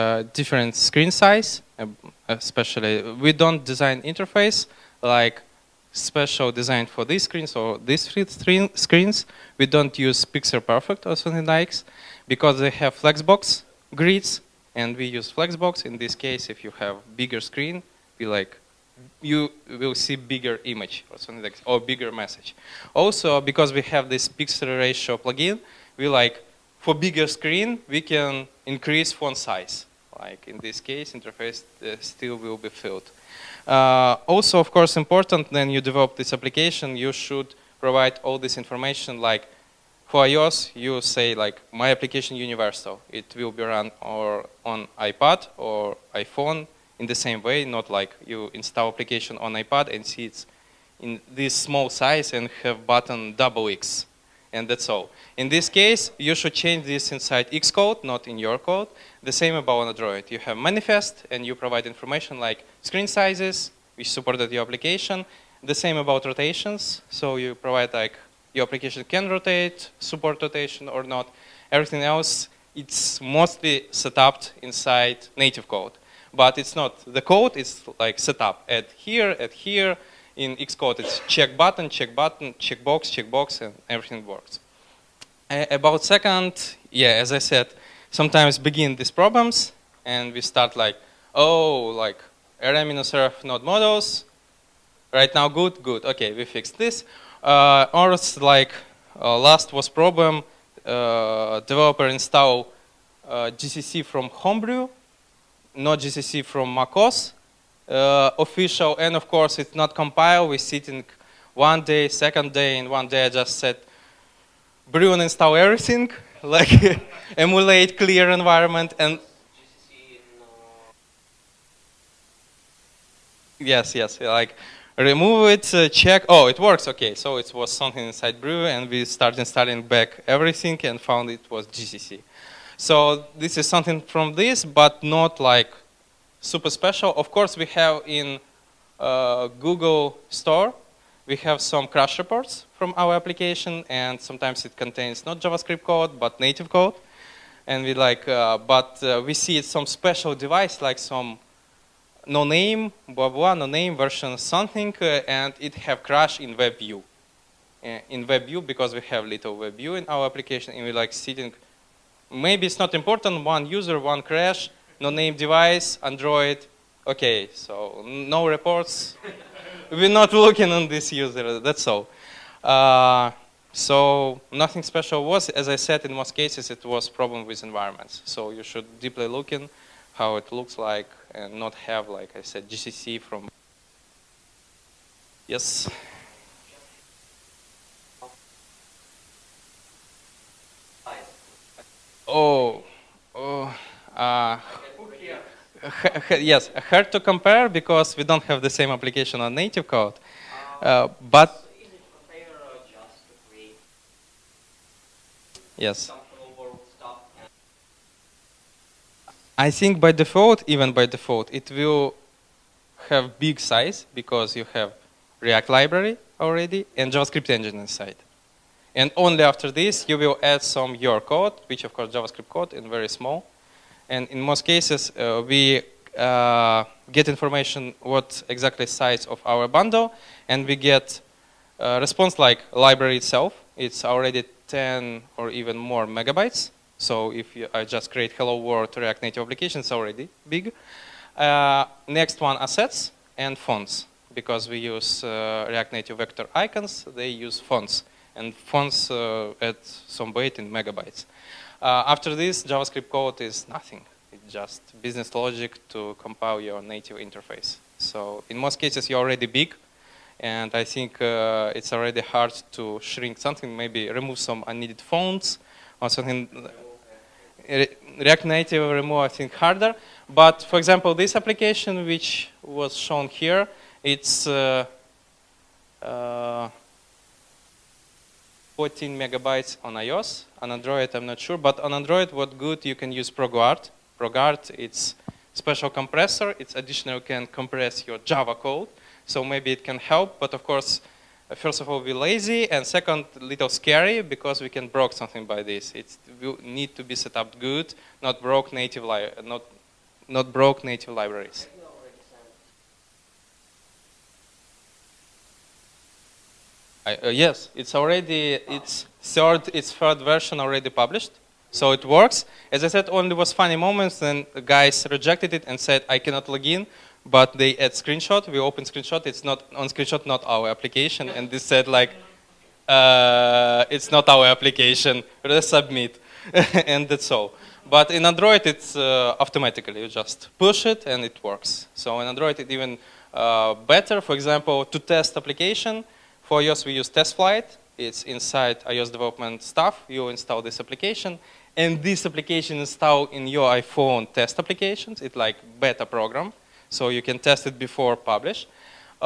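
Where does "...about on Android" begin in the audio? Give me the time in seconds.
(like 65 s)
59 s.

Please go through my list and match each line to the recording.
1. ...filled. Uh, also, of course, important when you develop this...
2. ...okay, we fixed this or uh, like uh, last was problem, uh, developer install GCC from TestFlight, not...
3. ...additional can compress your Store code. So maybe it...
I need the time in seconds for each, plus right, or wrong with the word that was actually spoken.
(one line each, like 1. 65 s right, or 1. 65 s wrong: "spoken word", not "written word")
1. 32 s right
2. 96 s wrong: "Homebrew", not "TestFlight"
3. 286 s wrong: "Java", not "Store".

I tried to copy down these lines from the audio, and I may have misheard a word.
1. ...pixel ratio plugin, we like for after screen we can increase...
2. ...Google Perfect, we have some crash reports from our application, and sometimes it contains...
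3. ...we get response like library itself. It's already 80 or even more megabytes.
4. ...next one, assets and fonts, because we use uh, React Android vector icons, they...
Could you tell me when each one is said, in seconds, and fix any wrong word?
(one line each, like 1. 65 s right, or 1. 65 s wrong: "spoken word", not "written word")
1. 24 s wrong: "bigger", not "after"
2. 139 s wrong: "Store", not "Perfect"
3. 230 s wrong: "10", not "80"
4. 242 s wrong: "Native", not "Android".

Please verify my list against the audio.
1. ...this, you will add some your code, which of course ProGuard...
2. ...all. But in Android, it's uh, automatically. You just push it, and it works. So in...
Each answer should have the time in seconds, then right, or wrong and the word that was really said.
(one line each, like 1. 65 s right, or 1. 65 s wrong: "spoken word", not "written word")
1. 219 s wrong: "JavaScript", not "ProGuard"
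2. 327 s right.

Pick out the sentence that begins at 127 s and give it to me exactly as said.
So it was something inside Brew, and we started installing back everything and found it was GCC.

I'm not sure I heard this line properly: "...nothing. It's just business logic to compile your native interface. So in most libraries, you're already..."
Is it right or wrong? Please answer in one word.
wrong.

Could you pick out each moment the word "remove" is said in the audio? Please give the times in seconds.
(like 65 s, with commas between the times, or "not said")
124 s, 264 s, 268 s.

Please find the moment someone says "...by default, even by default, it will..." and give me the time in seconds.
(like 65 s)
210 s.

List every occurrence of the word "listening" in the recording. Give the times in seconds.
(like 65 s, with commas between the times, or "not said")
not said.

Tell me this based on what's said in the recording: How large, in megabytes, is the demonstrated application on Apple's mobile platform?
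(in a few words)
14 megabytes.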